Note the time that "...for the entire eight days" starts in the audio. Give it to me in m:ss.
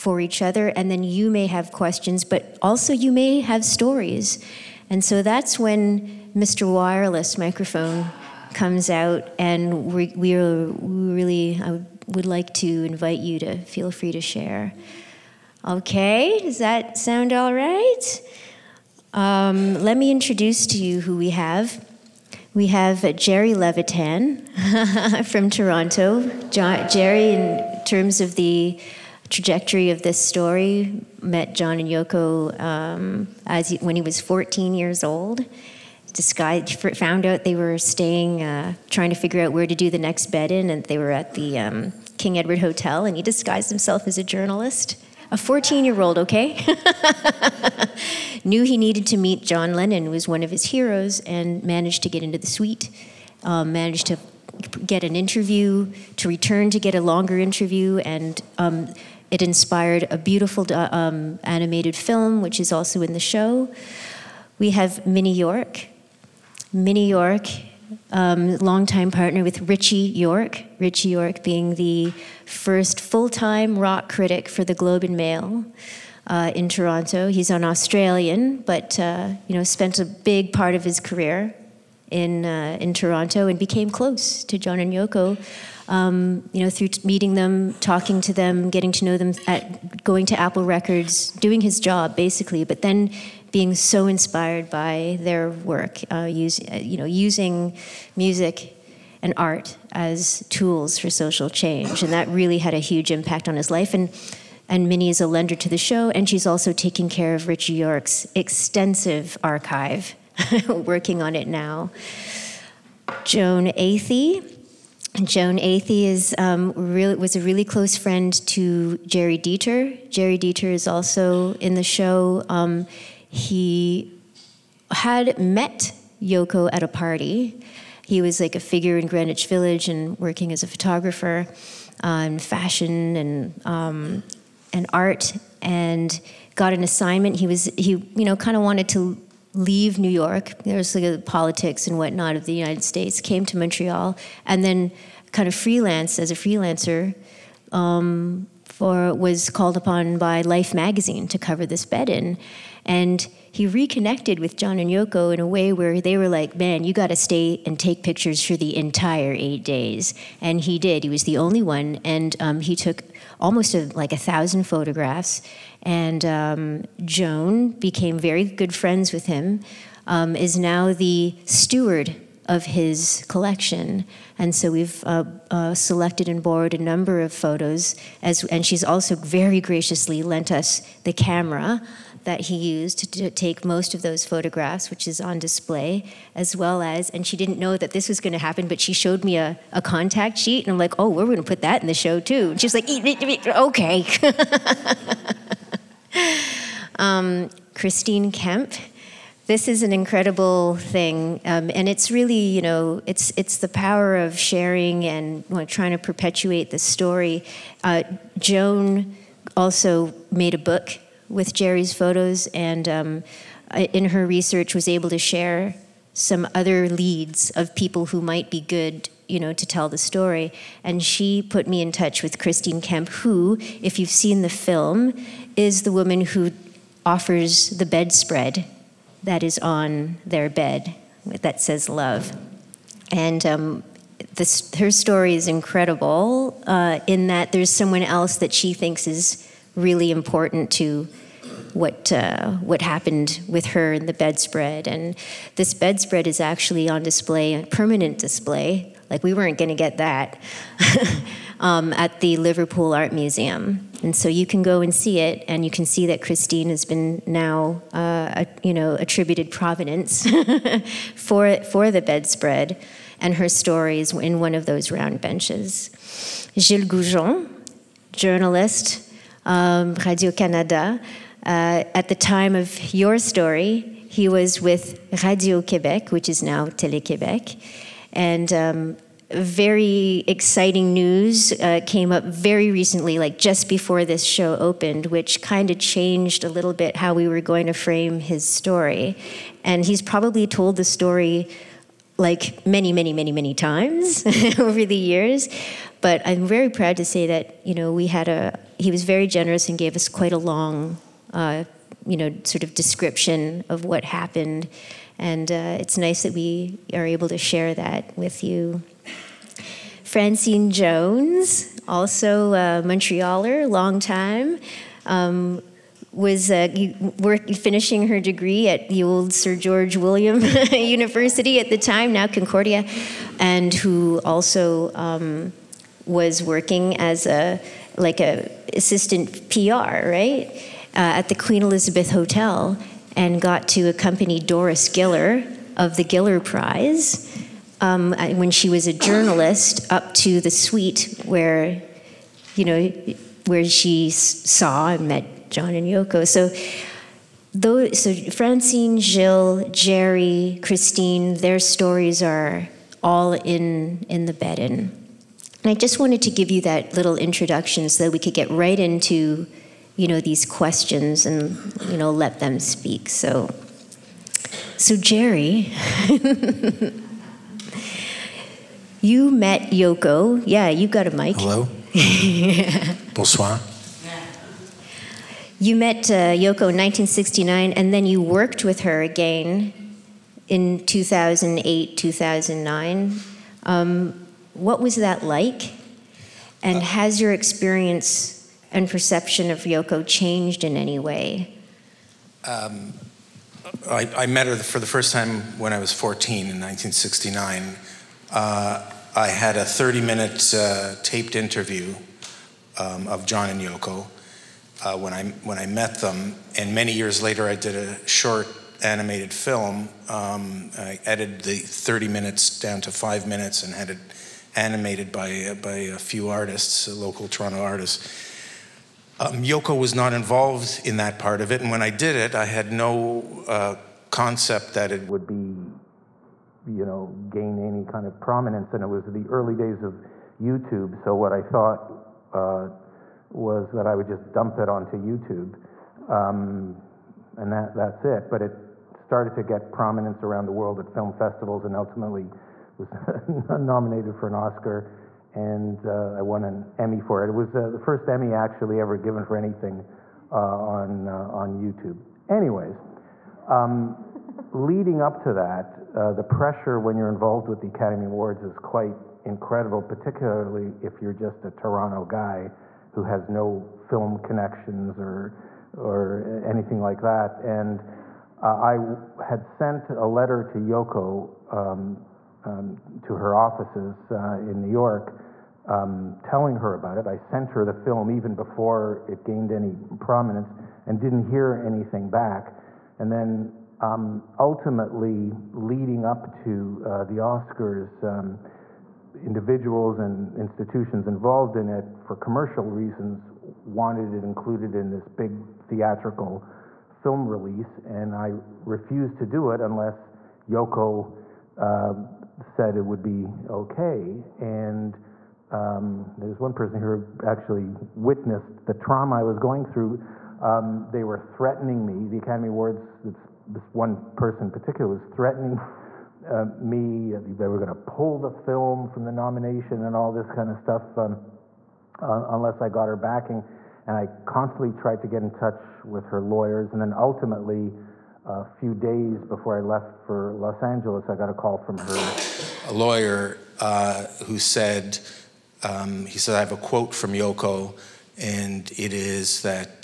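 2:38.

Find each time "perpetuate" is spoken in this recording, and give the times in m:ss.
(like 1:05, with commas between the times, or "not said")
3:25.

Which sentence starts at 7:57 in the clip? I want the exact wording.
I sent her the film even before it gained any prominence and didn't hear anything back.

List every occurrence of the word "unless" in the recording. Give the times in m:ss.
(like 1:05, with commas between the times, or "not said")
8:19, 8:42.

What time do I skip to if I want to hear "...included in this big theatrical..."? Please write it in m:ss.
8:14.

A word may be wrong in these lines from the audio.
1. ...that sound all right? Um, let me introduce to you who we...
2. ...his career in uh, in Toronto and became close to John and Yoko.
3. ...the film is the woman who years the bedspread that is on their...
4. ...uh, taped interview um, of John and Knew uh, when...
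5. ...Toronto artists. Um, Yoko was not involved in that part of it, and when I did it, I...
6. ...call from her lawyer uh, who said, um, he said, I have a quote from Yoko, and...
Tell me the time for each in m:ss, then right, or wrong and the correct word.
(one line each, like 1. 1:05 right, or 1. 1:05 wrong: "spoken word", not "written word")
1. 0:16 right
2. 1:20 right
3. 3:44 wrong: "offers", not "years"
4. 6:40 wrong: "Yoko", not "Knew"
5. 6:57 right
6. 8:51 right.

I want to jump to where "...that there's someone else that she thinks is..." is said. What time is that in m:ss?
3:57.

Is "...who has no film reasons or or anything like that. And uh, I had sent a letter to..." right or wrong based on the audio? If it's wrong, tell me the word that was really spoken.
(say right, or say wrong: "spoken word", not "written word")
wrong: "connections", not "reasons".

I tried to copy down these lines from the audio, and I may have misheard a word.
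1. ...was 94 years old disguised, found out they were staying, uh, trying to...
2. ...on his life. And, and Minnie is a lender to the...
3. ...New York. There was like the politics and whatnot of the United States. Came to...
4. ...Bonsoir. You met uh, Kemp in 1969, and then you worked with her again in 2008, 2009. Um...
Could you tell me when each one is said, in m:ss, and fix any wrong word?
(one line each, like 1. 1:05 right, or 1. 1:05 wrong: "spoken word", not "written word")
1. 0:34 wrong: "14", not "94"
2. 1:43 right
3. 2:19 right
4. 6:13 wrong: "Yoko", not "Kemp".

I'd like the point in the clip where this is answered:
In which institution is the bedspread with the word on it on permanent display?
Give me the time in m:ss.
4:12.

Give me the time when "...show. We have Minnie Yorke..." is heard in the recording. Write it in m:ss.
1:03.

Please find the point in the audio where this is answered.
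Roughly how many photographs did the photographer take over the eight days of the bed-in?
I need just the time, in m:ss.
2:44.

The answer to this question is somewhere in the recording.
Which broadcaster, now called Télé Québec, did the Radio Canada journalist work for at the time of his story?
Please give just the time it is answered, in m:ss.
4:35.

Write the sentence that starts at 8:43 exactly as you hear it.
And I constantly tried to get in touch with her lawyers.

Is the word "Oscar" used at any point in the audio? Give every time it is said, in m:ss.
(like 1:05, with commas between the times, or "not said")
7:24, 8:07.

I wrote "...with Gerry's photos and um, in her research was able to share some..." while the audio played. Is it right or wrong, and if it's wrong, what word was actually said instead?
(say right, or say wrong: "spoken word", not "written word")
right.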